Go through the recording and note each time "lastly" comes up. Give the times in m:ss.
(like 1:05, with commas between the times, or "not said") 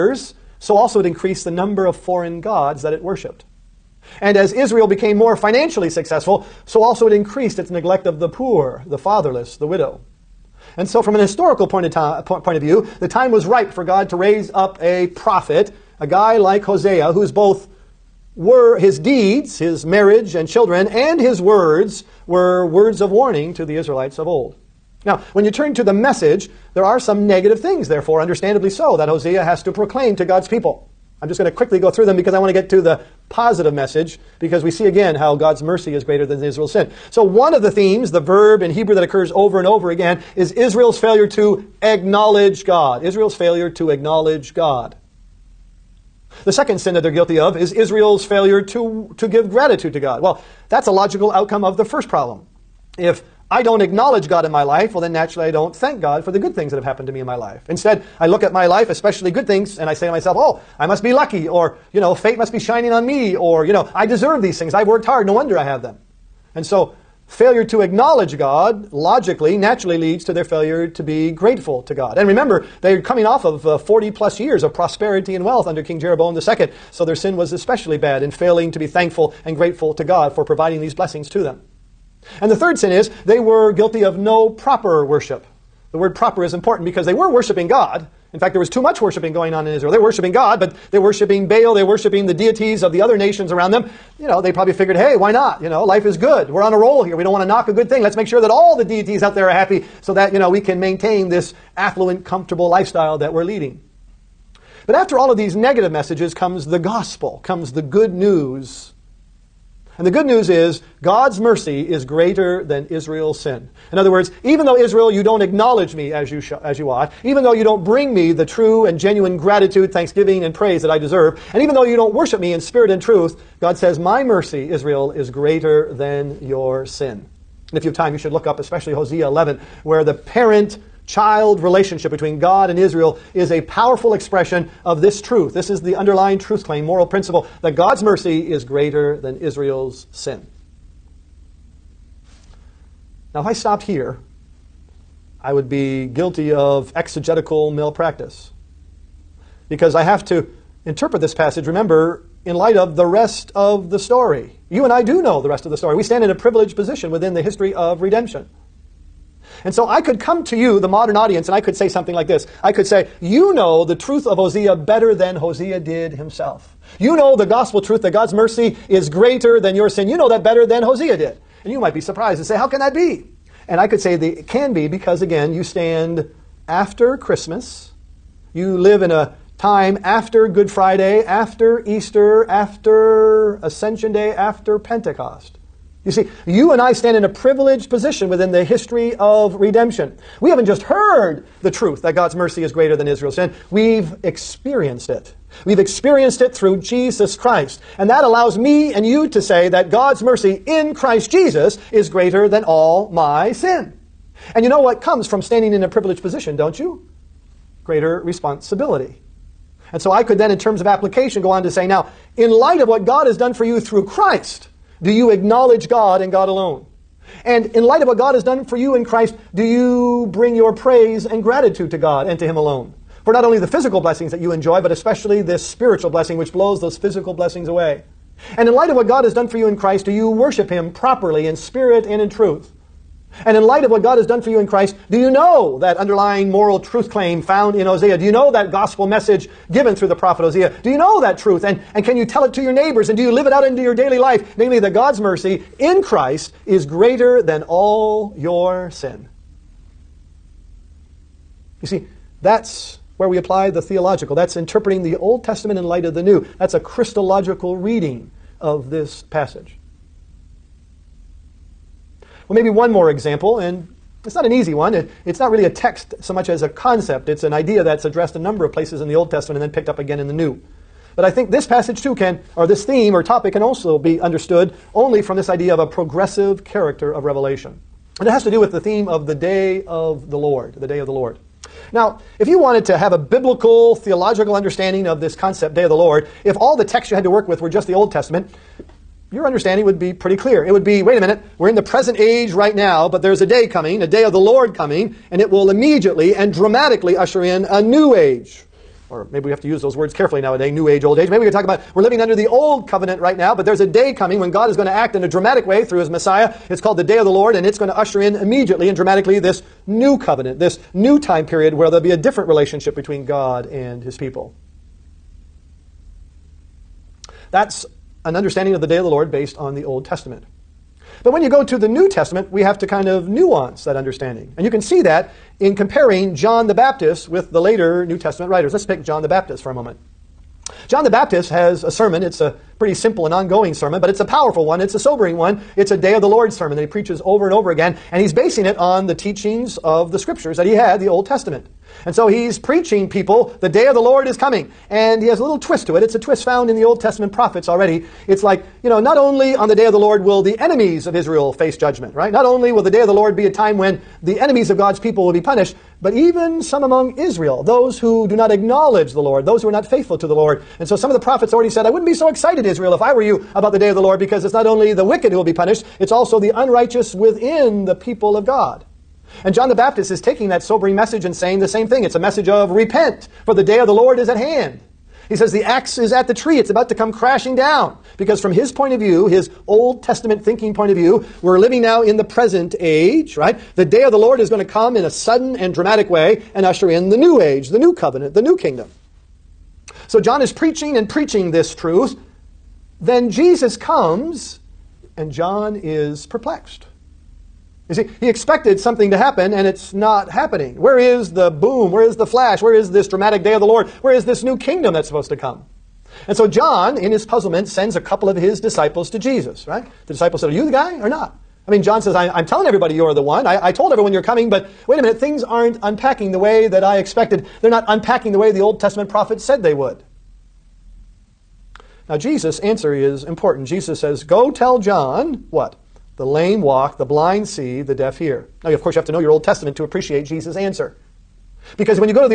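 not said.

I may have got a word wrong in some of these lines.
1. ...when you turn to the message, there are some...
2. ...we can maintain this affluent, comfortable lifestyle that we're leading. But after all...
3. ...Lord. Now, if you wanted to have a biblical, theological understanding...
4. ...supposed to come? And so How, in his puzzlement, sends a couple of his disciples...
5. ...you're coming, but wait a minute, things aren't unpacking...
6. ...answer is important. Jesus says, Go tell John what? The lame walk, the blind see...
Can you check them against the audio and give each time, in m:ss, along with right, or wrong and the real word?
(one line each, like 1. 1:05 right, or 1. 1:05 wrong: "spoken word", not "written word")
1. 0:25 right
2. 1:40 right
3. 4:41 right
4. 6:45 wrong: "John", not "How"
5. 6:54 right
6. 7:02 right.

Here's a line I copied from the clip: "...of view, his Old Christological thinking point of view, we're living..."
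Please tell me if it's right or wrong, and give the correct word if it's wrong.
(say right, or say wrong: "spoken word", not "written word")
wrong: "Testament", not "Christological".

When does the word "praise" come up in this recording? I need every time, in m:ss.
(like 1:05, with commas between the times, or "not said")
2:00, 3:40.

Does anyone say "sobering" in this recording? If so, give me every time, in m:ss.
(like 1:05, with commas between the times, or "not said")
5:34, 6:10.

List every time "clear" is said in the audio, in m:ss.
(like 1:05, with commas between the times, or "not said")
4:50.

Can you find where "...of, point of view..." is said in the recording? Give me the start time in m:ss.
0:11.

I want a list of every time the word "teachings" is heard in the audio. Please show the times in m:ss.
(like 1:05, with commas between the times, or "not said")
5:39.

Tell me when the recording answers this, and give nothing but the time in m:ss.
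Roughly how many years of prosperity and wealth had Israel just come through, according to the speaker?
1:13.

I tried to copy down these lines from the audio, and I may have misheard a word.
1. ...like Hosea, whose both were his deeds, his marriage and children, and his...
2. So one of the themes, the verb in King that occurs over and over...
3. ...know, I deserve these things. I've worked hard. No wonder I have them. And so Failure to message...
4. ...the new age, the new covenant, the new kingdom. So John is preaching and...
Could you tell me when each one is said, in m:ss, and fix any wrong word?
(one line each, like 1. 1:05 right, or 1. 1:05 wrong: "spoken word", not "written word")
1. 0:16 right
2. 0:37 wrong: "Hebrew", not "King"
3. 1:03 wrong: "acknowledge", not "message"
4. 6:27 right.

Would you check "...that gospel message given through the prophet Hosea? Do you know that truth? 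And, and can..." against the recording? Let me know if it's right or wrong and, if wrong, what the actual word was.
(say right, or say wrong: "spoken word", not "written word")
right.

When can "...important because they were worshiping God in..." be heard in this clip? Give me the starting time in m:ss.
1:26.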